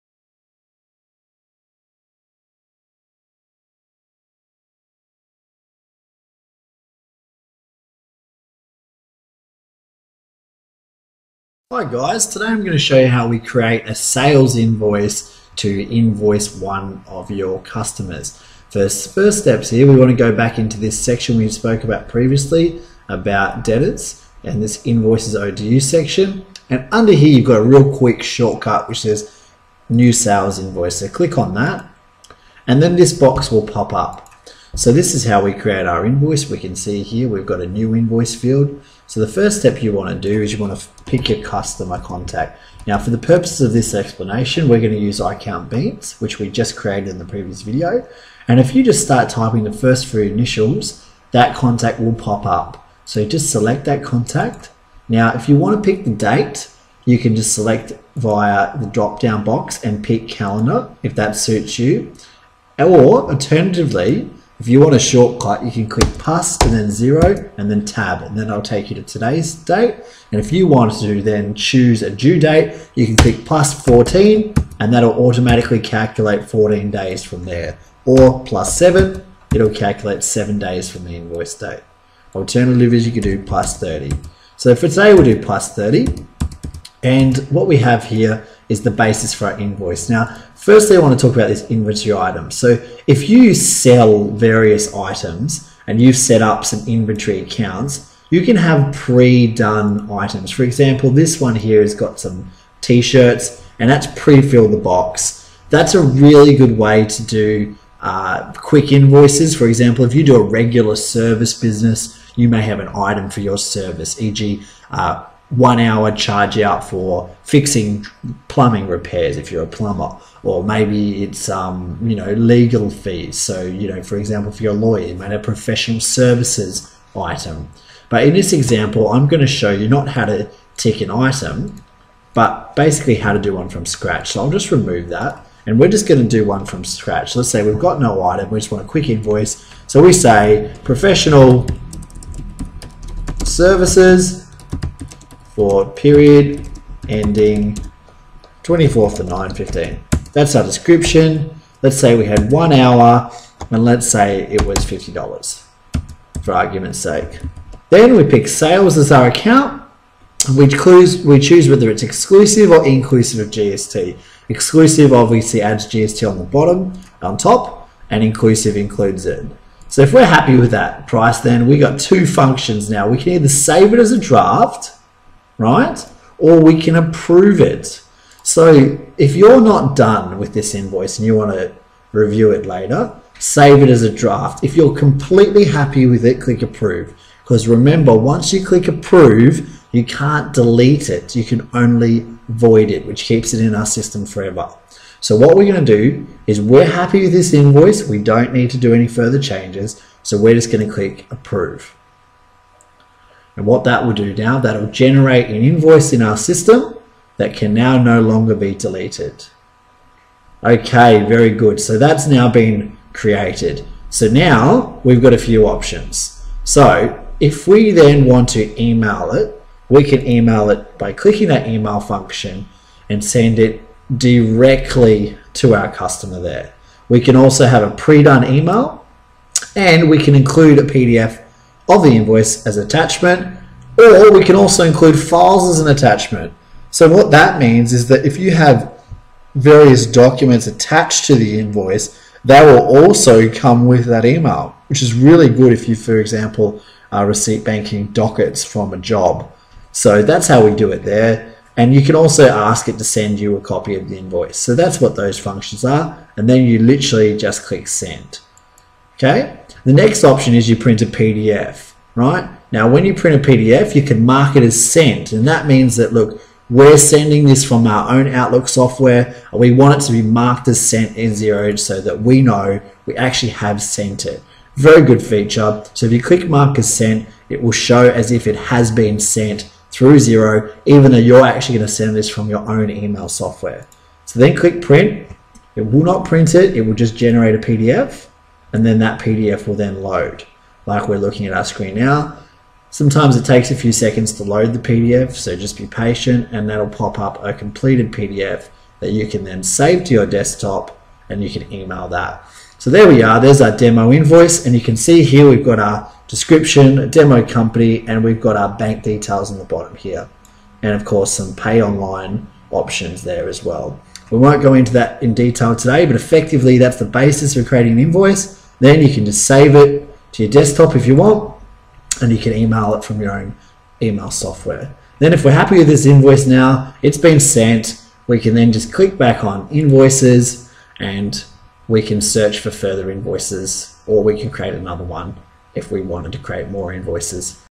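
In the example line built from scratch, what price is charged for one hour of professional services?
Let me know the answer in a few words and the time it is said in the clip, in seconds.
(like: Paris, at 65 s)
$50, at 154 s.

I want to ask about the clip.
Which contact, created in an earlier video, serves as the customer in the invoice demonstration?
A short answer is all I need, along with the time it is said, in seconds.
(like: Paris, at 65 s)
iCount Beans, at 45 s.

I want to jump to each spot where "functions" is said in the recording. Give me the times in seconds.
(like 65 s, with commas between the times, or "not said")
172 s, 221 s, 255 s.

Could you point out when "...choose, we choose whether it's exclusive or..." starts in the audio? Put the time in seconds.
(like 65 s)
160 s.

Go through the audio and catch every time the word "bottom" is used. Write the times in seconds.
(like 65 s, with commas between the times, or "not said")
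166 s, 309 s.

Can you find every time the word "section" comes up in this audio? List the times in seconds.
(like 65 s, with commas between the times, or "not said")
20 s, 25 s.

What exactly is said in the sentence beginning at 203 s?
And what that will do now, that'll generate an invoice in our system that can now no longer be deleted.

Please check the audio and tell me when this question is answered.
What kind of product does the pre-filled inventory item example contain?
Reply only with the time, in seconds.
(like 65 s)
102 s.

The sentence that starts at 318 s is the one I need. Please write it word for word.
Then you can just save it to your desktop if you want, and you can email it from your own email software.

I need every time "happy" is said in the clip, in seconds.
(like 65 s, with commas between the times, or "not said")
170 s, 185 s, 196 s, 325 s.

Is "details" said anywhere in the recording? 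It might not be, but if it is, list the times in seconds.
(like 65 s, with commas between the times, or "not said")
309 s, 315 s.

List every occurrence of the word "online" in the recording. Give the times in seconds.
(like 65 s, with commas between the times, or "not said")
311 s.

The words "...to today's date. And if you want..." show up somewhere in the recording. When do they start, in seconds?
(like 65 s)
68 s.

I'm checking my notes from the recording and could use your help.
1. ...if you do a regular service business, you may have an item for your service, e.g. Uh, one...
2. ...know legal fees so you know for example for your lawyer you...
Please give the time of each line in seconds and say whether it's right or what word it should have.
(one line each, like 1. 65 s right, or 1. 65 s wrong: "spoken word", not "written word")
1. 110 s right
2. 122 s right.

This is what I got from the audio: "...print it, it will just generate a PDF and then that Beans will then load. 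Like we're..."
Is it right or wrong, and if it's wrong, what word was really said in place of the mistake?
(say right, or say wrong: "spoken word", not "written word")
wrong: "PDF", not "Beans".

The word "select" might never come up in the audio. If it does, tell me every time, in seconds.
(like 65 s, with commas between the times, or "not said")
53 s, 57 s.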